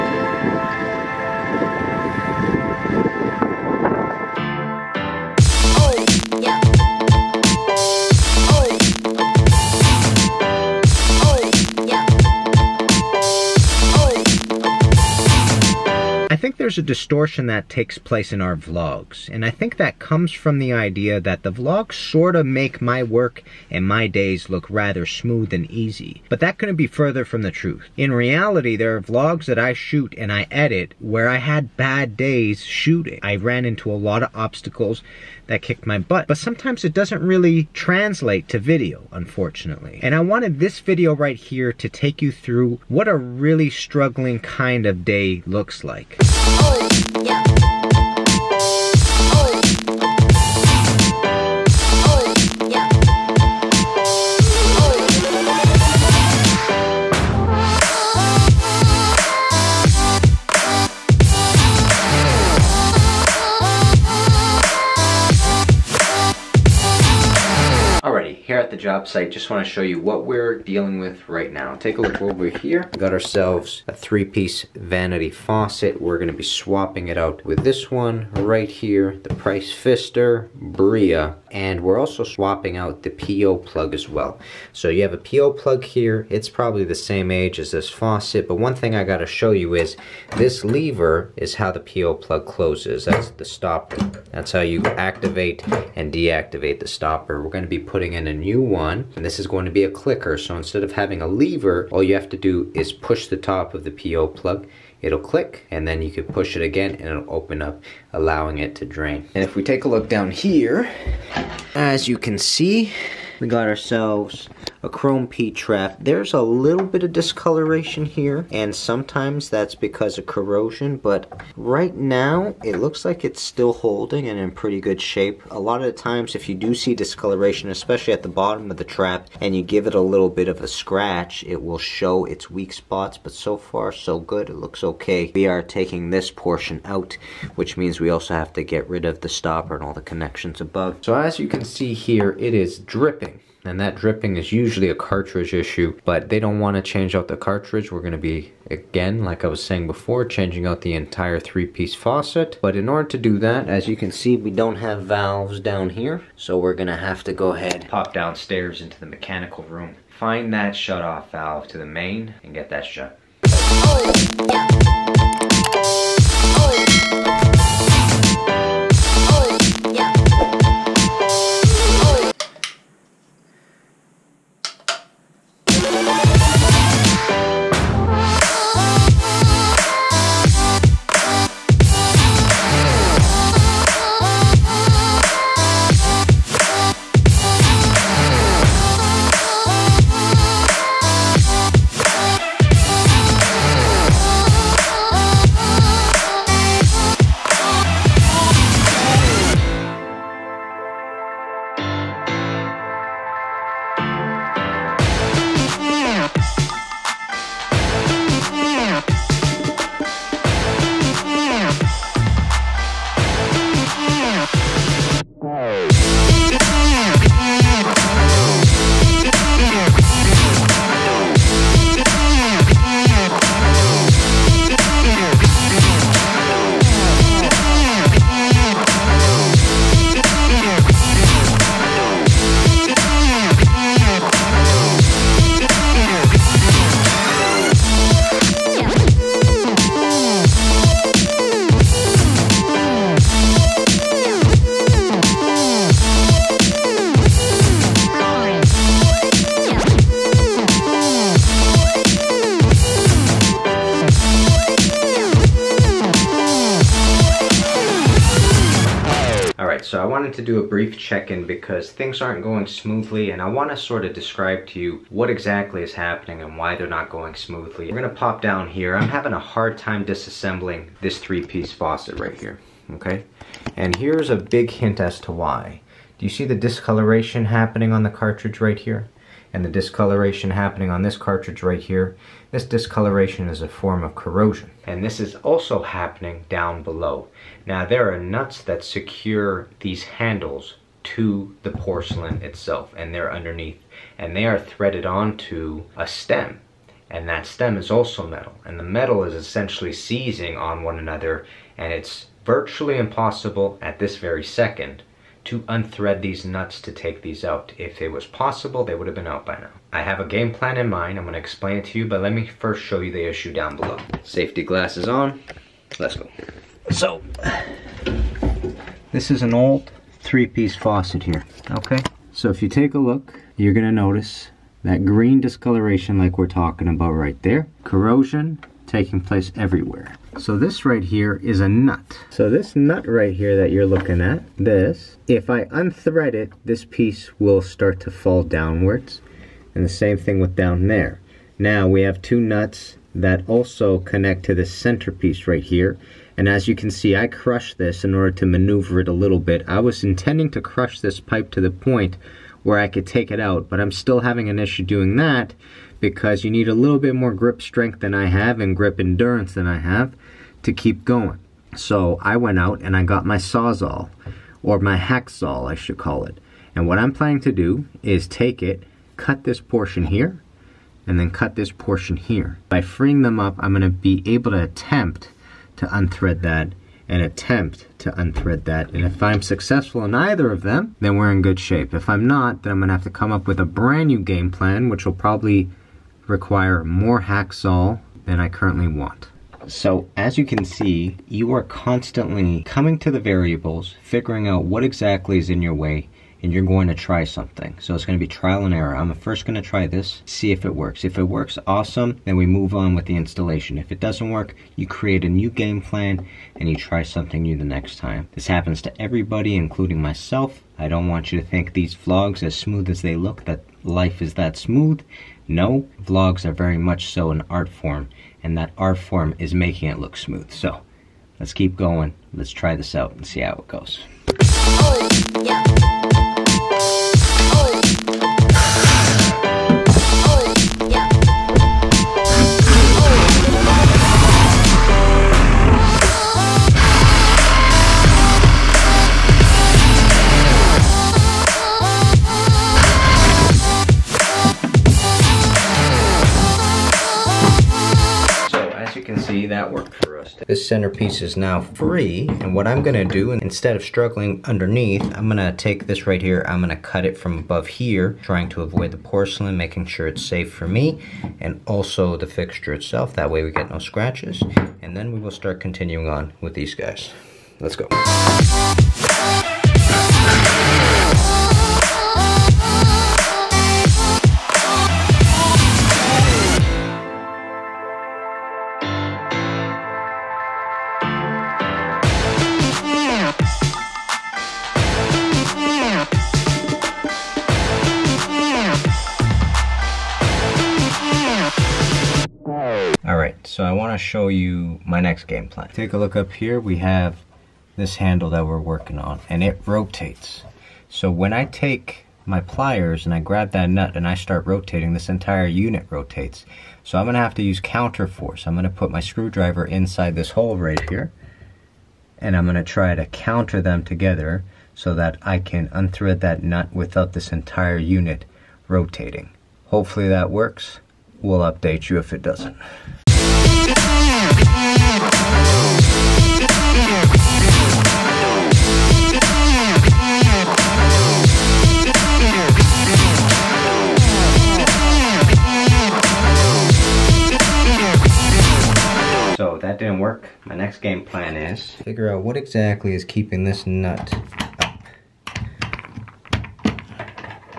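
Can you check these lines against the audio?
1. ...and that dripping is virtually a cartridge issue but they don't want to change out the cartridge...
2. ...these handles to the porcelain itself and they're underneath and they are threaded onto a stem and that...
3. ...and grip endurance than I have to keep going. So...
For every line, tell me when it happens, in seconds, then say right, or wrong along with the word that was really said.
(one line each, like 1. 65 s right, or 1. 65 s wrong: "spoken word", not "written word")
1. 143 s wrong: "usually", not "virtually"
2. 289 s right
3. 358 s right.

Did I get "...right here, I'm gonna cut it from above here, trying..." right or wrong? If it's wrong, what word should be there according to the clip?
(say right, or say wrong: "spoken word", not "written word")
right.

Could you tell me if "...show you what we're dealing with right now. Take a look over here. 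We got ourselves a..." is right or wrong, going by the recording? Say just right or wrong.
right.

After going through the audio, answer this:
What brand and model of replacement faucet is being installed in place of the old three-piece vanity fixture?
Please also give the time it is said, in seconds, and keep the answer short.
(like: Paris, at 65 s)
Price Pfister Bria, at 79 s.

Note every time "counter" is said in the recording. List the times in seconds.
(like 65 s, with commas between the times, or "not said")
507 s, 513 s.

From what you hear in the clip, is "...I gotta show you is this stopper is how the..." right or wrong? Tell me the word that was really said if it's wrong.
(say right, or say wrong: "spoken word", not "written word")
wrong: "lever", not "stopper".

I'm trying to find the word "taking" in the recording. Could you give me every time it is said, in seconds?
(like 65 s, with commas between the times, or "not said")
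135 s, 328 s.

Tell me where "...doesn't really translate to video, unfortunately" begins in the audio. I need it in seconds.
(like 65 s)
36 s.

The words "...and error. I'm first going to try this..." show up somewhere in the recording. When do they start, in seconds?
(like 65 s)
398 s.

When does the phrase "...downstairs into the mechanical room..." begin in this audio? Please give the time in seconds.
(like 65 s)
158 s.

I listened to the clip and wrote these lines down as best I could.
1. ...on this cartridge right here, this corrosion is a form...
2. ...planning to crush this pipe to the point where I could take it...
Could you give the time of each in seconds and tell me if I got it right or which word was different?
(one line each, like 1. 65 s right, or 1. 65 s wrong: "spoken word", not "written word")
1. 280 s wrong: "discoloration", not "corrosion"
2. 350 s wrong: "intending", not "planning".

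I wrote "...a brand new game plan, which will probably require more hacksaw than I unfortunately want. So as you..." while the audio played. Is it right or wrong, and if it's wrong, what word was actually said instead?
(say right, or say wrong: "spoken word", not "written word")
wrong: "currently", not "unfortunately".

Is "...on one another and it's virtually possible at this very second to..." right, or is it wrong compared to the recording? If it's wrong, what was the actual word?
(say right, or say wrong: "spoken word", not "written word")
wrong: "impossible", not "possible".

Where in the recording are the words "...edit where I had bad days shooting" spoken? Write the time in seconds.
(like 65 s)
30 s.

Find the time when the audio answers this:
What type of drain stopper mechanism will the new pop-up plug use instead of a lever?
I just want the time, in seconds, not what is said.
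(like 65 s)
99 s.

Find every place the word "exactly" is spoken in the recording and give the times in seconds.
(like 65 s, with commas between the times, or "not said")
265 s, 394 s, 542 s.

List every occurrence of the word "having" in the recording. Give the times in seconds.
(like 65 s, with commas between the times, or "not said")
100 s, 269 s, 354 s.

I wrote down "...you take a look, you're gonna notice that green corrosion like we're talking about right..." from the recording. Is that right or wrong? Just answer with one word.
wrong.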